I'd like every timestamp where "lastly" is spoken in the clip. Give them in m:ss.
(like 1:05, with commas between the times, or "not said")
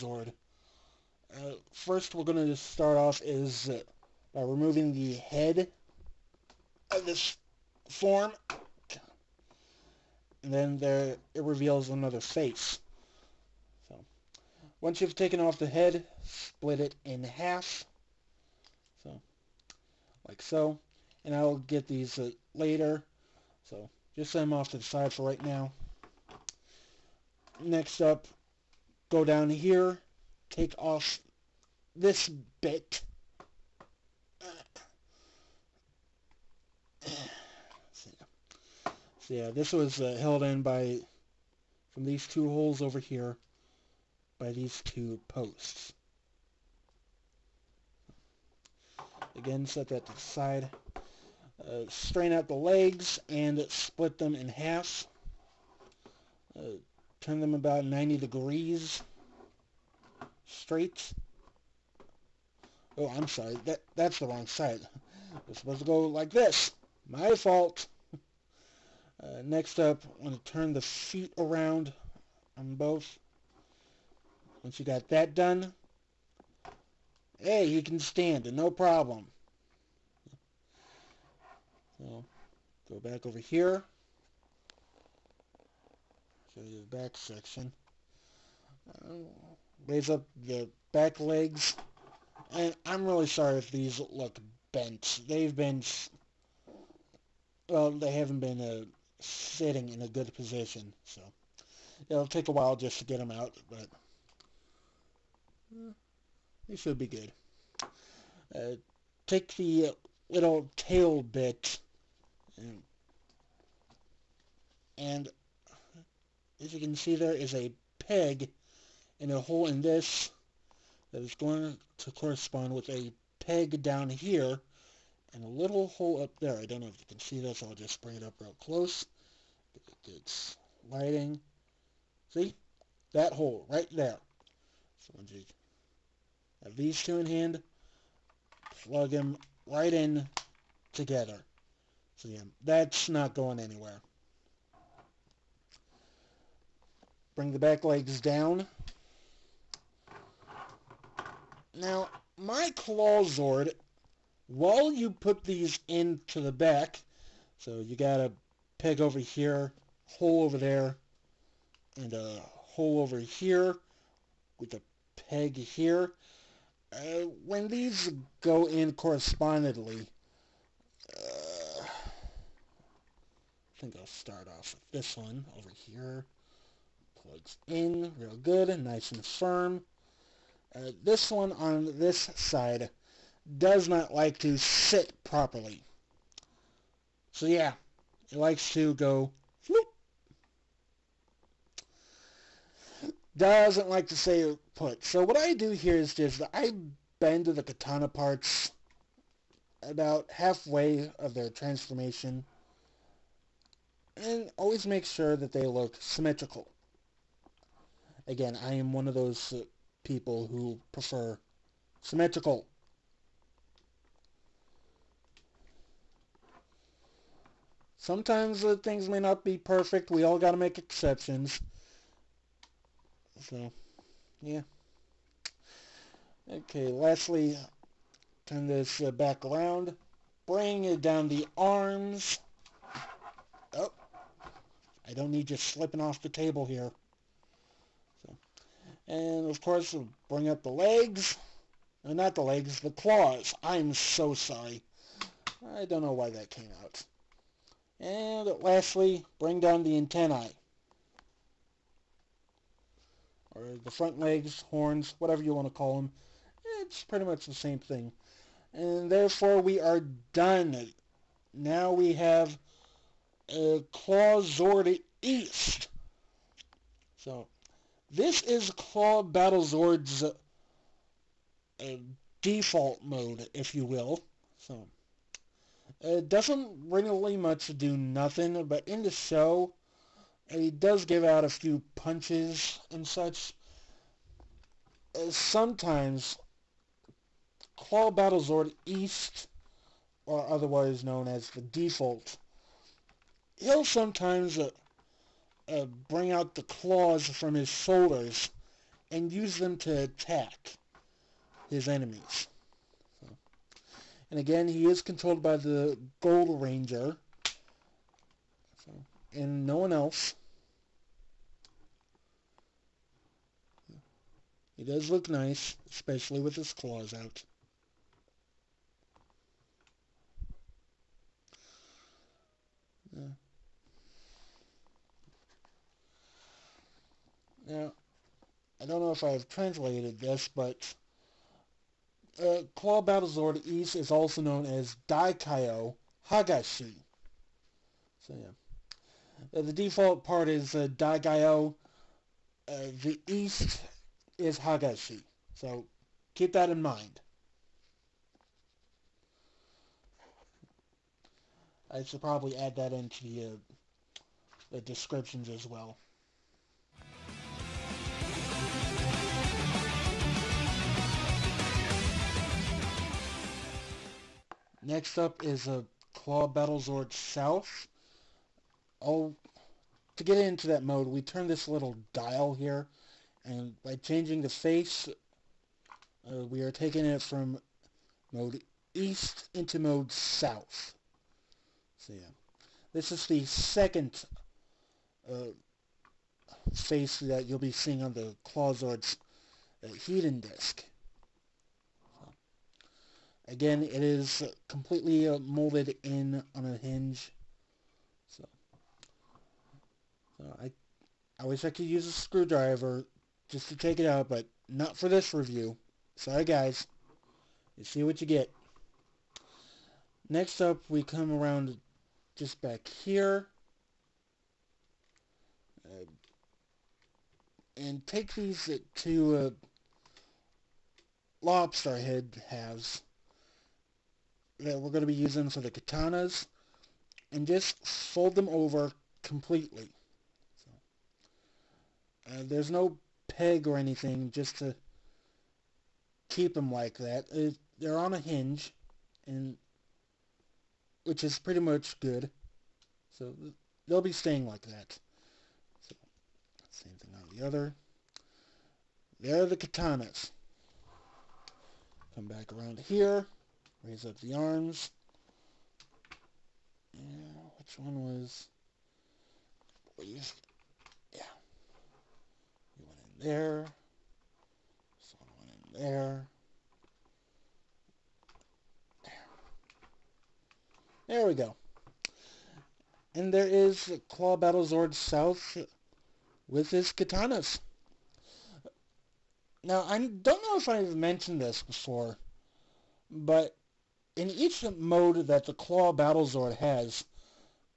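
3:46, 4:08.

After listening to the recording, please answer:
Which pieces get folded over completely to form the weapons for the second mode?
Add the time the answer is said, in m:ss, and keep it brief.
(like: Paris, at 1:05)
Lobster head halves, at 7:01.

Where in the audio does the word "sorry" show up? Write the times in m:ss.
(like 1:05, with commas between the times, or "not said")
1:03, 1:33, 4:04, 6:46.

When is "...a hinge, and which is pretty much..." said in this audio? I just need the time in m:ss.
7:18.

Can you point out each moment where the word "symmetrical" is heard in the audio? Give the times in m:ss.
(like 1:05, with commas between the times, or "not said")
3:25, 3:31.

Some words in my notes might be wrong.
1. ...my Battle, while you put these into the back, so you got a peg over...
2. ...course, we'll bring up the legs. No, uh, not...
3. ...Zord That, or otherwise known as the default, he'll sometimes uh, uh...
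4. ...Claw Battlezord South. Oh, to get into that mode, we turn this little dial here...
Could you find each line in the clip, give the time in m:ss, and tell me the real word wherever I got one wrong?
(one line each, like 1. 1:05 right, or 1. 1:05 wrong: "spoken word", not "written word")
1. 2:32 wrong: "Clawzord", not "Battle"
2. 3:59 right
3. 4:48 wrong: "East", not "That"
4. 6:06 right.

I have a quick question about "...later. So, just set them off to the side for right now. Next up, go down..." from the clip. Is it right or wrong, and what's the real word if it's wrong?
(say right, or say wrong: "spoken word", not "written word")
right.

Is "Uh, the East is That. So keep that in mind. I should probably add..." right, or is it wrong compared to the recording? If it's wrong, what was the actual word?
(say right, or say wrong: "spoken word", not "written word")
wrong: "Higashi", not "That".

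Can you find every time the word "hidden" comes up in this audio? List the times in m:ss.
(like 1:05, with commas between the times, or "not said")
6:29.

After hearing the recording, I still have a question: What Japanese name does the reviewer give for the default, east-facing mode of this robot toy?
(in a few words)
Daikai-Oh Higashi.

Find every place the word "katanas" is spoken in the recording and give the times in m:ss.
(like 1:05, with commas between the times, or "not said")
3:17, 7:05, 7:29, 7:56.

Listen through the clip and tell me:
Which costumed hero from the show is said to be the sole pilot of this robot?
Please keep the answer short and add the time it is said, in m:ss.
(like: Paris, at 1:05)
Gold Ranger, at 5:06.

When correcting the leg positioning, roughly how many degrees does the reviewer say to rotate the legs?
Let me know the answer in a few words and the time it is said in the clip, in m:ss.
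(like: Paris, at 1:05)
90, at 0:57.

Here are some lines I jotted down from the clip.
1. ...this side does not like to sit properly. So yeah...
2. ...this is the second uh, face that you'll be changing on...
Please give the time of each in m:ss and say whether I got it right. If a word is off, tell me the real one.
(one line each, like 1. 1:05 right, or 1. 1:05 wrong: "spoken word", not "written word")
1. 3:01 right
2. 6:22 wrong: "seeing", not "changing".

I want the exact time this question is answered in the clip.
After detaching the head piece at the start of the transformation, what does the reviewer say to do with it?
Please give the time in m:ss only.
0:16.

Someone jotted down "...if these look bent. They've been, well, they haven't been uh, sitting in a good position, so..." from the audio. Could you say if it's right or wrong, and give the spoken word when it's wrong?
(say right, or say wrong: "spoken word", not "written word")
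right.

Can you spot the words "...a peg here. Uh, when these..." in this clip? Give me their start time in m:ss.
2:44.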